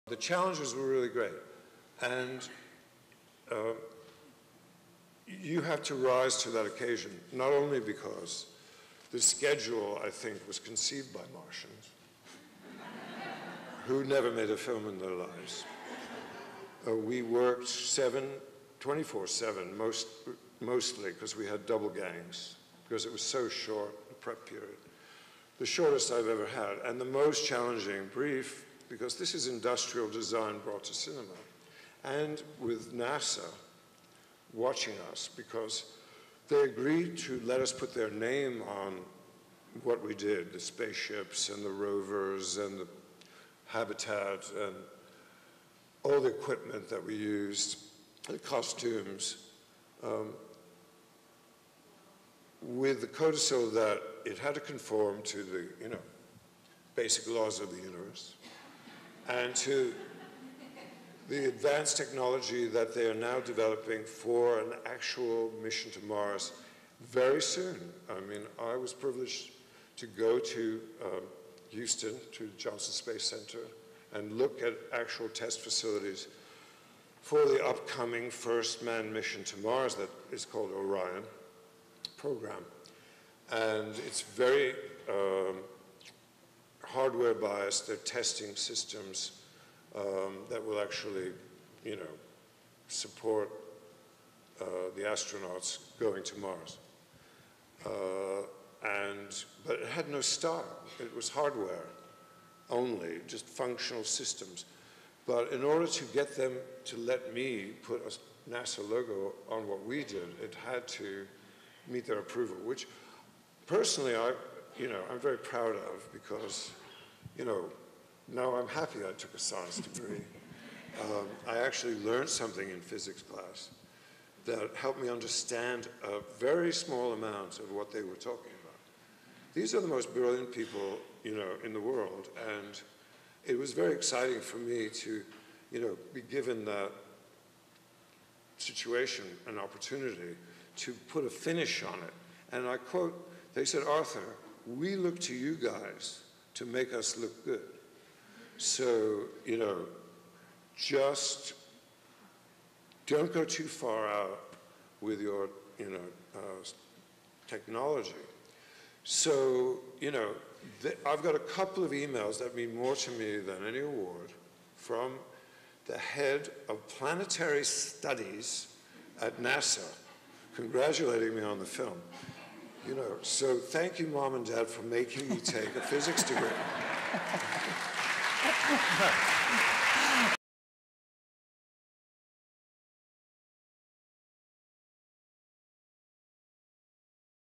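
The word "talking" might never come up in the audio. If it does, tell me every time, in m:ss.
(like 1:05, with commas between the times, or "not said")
2:08.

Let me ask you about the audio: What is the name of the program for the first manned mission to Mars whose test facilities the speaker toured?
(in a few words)
Orion.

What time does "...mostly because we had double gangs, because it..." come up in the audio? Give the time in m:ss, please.
0:20.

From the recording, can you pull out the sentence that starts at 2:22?
And I quote, they said, Arthur, we look to you guys to make us look good.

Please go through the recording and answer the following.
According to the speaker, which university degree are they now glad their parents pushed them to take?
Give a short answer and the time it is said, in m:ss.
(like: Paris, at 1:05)
physics degree, at 2:55.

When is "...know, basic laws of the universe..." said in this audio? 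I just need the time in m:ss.
0:55.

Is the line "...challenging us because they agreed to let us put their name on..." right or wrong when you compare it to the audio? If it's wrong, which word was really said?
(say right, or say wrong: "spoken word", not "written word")
wrong: "watching", not "challenging".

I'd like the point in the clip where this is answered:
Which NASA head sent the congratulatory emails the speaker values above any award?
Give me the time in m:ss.
2:46.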